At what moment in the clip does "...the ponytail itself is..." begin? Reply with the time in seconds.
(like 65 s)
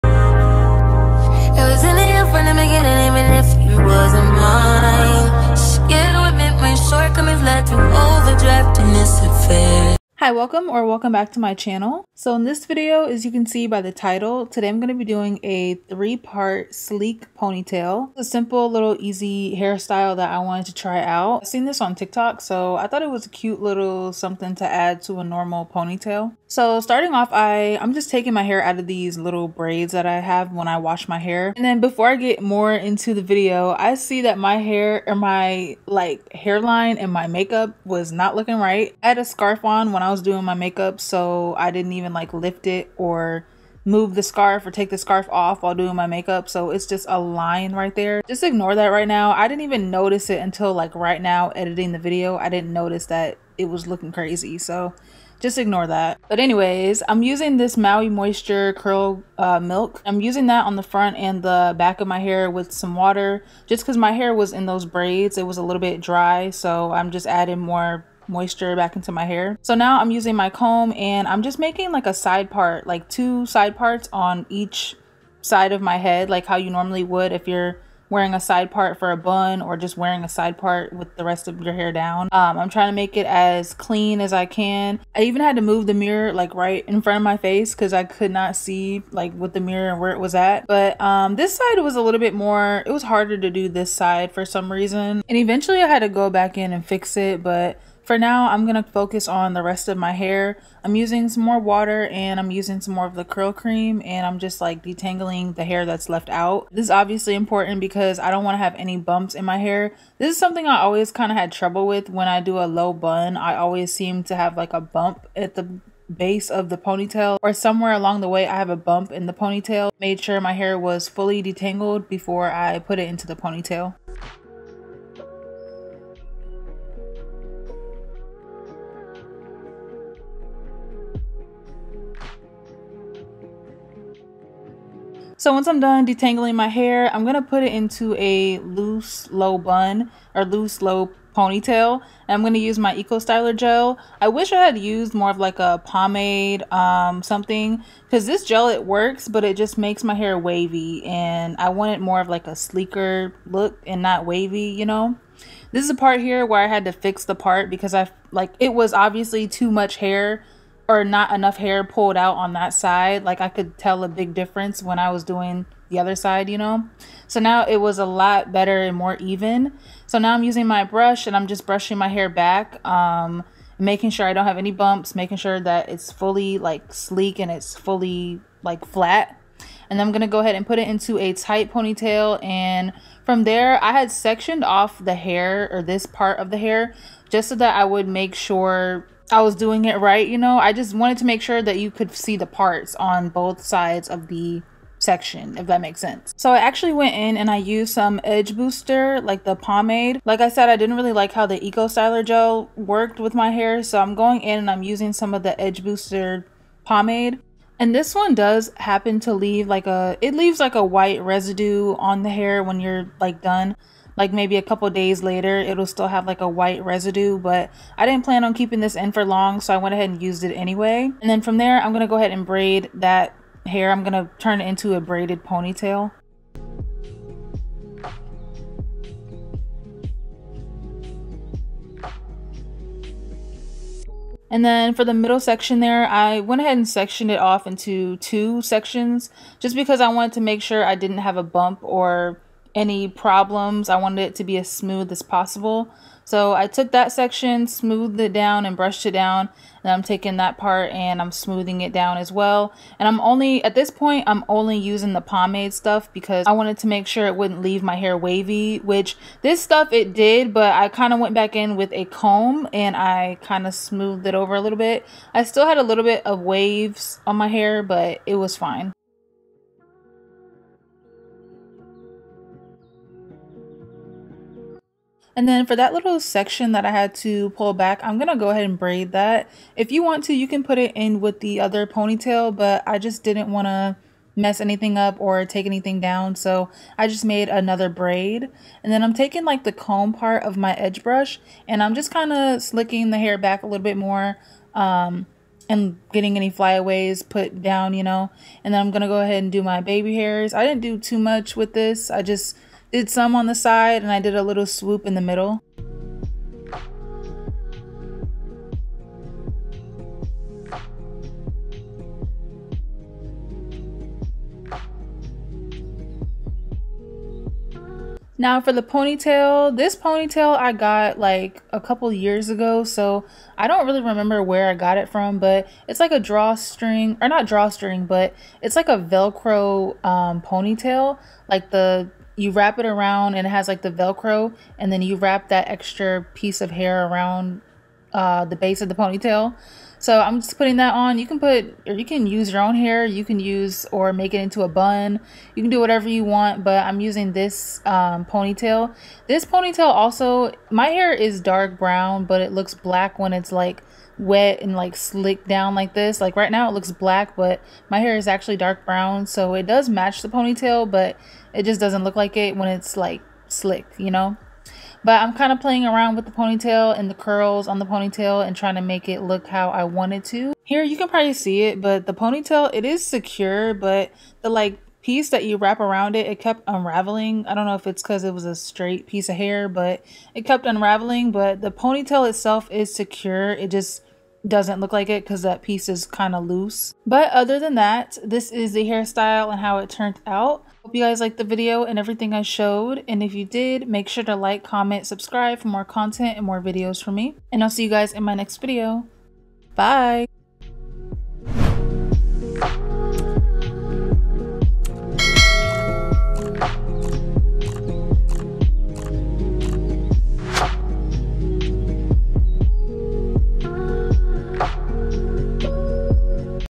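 381 s.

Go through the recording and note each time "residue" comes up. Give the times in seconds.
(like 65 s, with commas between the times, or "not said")
211 s, 216 s.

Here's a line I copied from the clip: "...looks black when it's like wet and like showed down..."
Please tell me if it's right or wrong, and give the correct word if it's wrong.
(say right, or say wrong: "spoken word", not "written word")
wrong: "slicked", not "showed".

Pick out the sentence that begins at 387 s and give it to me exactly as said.
But other than that, this is the hairstyle and how it turned out.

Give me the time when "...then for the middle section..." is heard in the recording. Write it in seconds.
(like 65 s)
234 s.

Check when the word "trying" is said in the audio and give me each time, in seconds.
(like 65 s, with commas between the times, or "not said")
82 s, 368 s.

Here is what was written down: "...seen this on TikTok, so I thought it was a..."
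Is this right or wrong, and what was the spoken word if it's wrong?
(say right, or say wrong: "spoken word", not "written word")
right.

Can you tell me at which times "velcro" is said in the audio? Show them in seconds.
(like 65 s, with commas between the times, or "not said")
328 s, 333 s.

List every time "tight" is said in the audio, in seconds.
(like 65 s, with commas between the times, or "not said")
181 s.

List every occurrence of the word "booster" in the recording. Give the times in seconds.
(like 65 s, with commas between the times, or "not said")
198 s, 205 s.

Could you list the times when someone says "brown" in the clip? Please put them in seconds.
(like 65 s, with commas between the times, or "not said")
351 s, 358 s.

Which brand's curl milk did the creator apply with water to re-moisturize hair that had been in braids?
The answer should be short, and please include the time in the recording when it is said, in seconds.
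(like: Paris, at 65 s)
Maui Moisture, at 57 s.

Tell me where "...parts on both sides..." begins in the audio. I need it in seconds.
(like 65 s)
192 s.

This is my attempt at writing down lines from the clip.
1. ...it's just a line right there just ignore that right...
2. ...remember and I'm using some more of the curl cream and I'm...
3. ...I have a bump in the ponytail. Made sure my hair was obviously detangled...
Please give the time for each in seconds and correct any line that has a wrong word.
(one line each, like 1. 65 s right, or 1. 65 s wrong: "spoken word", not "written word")
1. 46 s right
2. 101 s wrong: "water", not "remember"
3. 118 s wrong: "fully", not "obviously".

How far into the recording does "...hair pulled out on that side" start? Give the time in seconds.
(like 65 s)
161 s.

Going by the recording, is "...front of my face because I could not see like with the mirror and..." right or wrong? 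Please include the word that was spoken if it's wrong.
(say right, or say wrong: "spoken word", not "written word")
right.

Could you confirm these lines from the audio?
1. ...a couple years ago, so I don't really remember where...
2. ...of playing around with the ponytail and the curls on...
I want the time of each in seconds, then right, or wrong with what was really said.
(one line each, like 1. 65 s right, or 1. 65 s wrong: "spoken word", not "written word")
1. 321 s right
2. 365 s right.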